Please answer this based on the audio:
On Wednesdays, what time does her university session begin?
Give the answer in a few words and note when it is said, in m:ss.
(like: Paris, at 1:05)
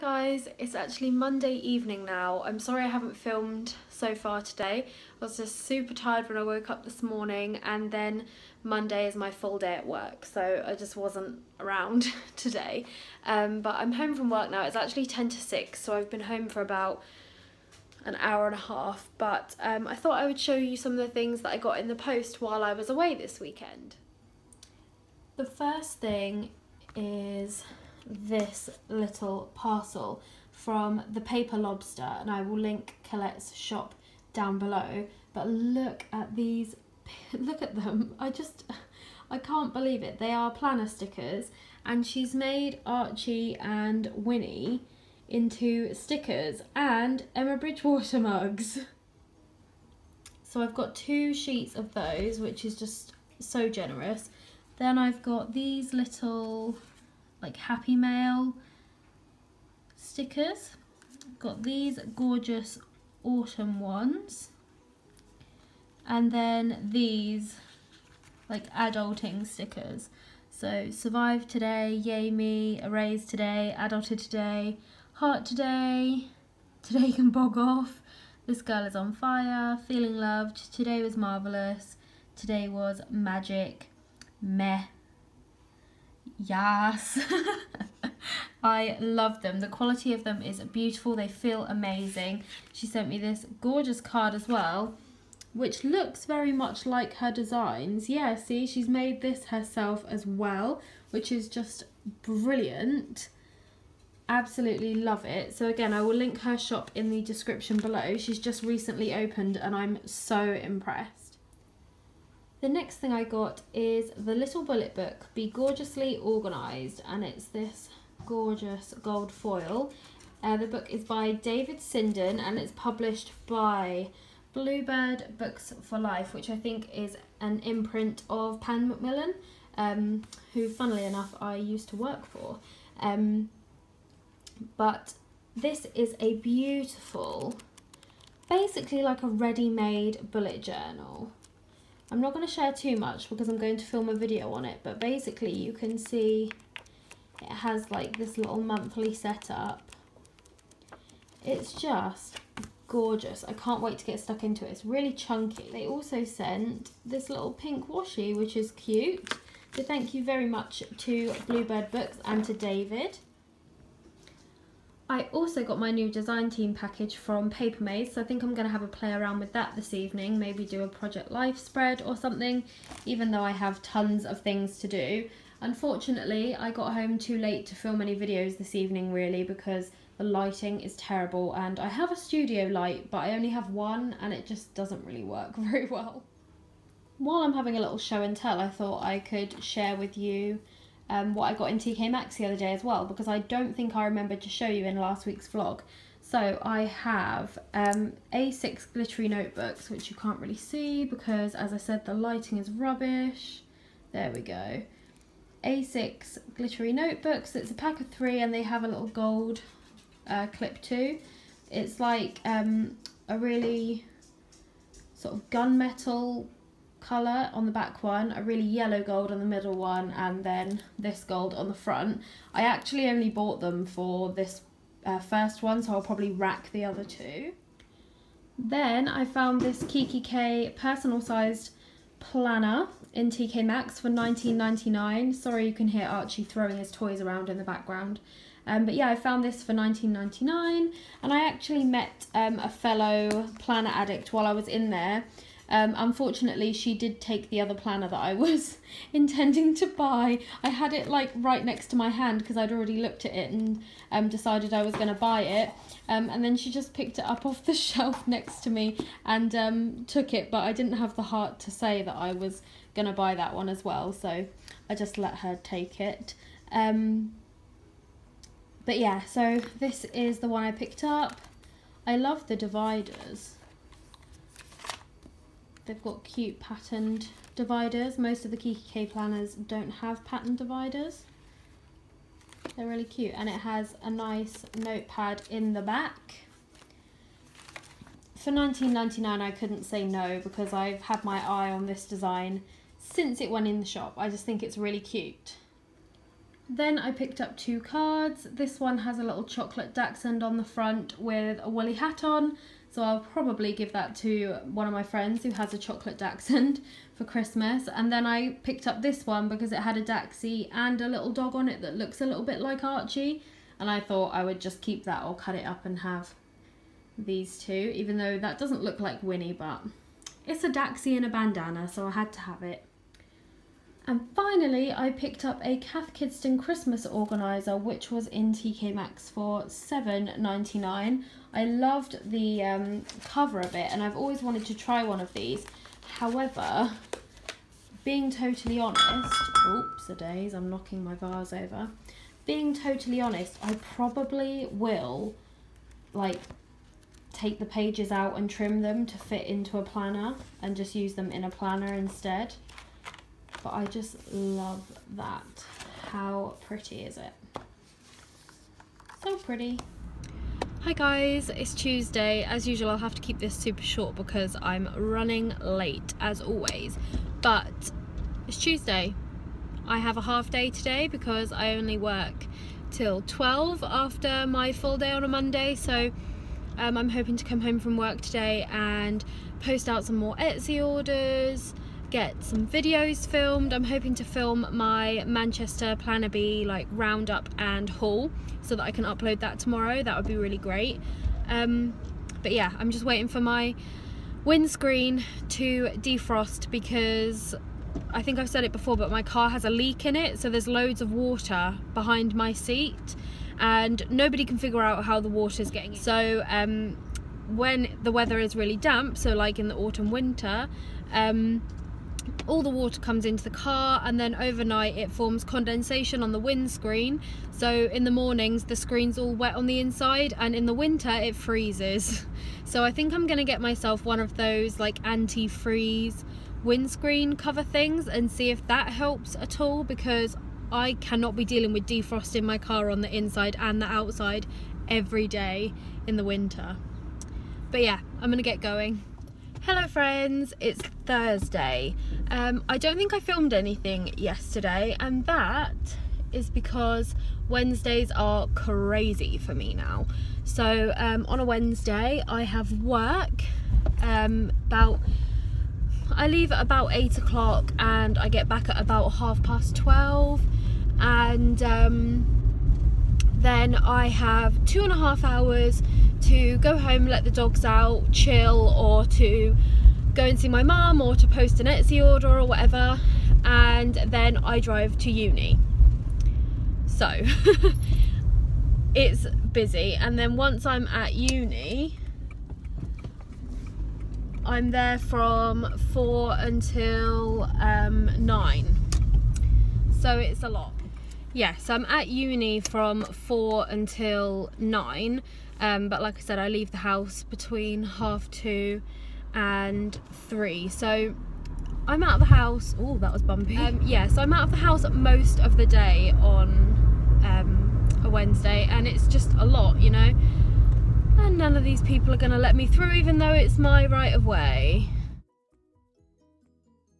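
4, at 8:05.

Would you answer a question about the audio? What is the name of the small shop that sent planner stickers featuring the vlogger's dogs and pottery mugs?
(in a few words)
The Paper Lobster.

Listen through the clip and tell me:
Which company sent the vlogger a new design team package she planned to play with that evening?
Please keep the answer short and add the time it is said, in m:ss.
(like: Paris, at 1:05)
Papermaze, at 2:47.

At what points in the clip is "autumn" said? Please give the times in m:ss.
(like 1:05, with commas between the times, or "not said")
1:03, 6:49.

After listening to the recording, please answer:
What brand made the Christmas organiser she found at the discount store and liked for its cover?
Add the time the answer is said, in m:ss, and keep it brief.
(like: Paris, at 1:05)
Cath Kidston, at 5:25.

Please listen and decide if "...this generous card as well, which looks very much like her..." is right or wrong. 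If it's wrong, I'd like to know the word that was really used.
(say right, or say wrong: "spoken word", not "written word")
wrong: "gorgeous", not "generous".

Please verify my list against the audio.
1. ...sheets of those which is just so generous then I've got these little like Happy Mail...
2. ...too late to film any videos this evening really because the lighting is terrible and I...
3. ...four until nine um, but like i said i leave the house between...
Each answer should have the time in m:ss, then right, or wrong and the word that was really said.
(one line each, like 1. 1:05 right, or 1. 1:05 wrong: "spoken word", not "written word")
1. 0:51 right
2. 2:57 right
3. 8:13 right.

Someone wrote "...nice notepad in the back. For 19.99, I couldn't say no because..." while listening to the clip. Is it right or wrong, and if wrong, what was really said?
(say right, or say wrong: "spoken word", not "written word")
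right.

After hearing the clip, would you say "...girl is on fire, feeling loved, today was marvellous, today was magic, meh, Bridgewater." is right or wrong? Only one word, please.
wrong.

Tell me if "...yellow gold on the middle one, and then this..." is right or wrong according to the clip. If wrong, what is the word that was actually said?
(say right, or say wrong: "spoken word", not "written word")
right.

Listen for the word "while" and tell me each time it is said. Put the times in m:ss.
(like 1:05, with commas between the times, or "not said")
0:22, 3:07, 4:04.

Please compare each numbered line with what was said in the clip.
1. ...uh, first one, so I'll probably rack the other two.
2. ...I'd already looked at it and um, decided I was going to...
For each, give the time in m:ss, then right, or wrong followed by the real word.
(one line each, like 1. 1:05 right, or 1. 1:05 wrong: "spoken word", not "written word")
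1. 3:45 right
2. 4:12 right.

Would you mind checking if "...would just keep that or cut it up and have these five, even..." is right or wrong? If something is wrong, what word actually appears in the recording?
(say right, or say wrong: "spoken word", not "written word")
wrong: "two", not "five".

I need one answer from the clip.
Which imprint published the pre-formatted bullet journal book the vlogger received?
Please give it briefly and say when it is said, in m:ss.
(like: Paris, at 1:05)
Bluebird Books for Life, at 2:04.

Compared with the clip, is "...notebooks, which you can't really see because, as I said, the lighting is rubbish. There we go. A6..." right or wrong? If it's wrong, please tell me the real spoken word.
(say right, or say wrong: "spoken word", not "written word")
right.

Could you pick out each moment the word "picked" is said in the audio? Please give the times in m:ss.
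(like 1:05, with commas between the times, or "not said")
4:16, 4:30, 4:57, 5:08, 5:25.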